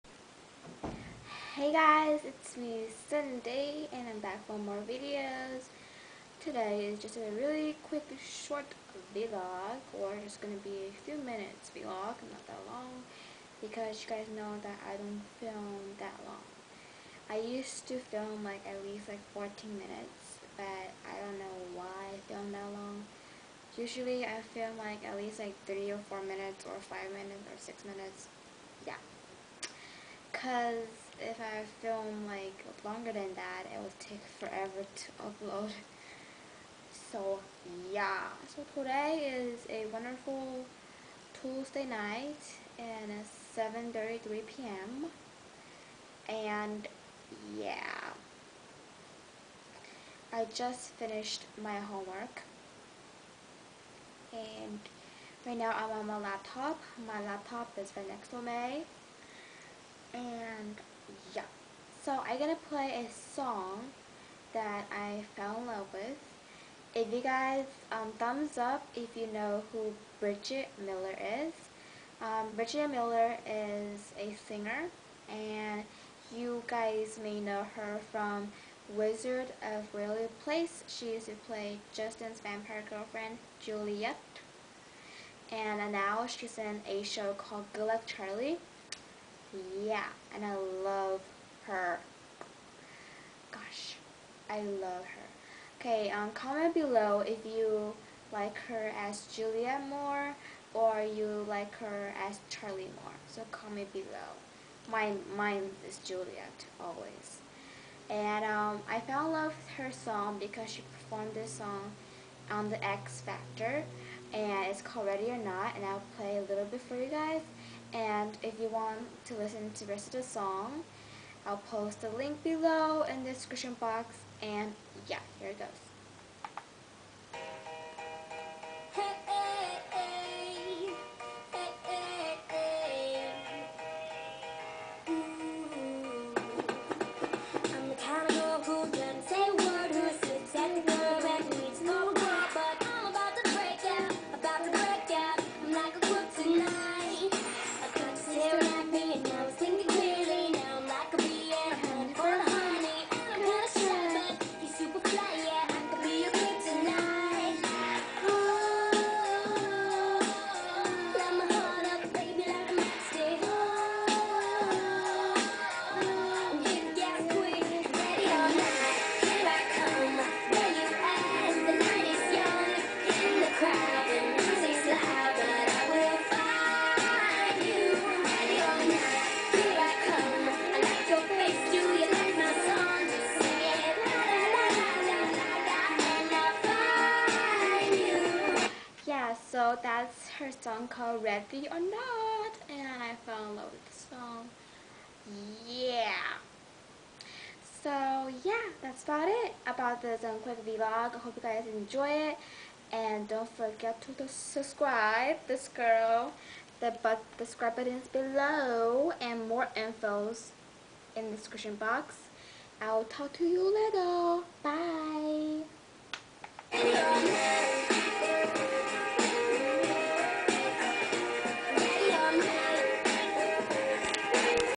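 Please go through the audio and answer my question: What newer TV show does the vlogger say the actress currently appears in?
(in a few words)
Good Luck Charlie.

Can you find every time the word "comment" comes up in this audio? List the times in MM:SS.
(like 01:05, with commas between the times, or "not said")
01:36, 01:43.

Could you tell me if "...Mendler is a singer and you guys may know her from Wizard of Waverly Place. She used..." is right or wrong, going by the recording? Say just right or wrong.
right.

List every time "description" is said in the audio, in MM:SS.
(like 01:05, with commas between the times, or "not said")
02:03, 03:31.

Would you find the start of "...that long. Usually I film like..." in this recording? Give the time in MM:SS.
00:22.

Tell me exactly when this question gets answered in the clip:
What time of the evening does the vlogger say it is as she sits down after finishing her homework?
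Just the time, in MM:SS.
00:43.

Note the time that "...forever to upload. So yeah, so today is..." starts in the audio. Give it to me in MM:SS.
00:34.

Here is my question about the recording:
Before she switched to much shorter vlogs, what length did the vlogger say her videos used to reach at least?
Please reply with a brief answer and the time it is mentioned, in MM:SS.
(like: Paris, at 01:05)
14 minutes, at 00:19.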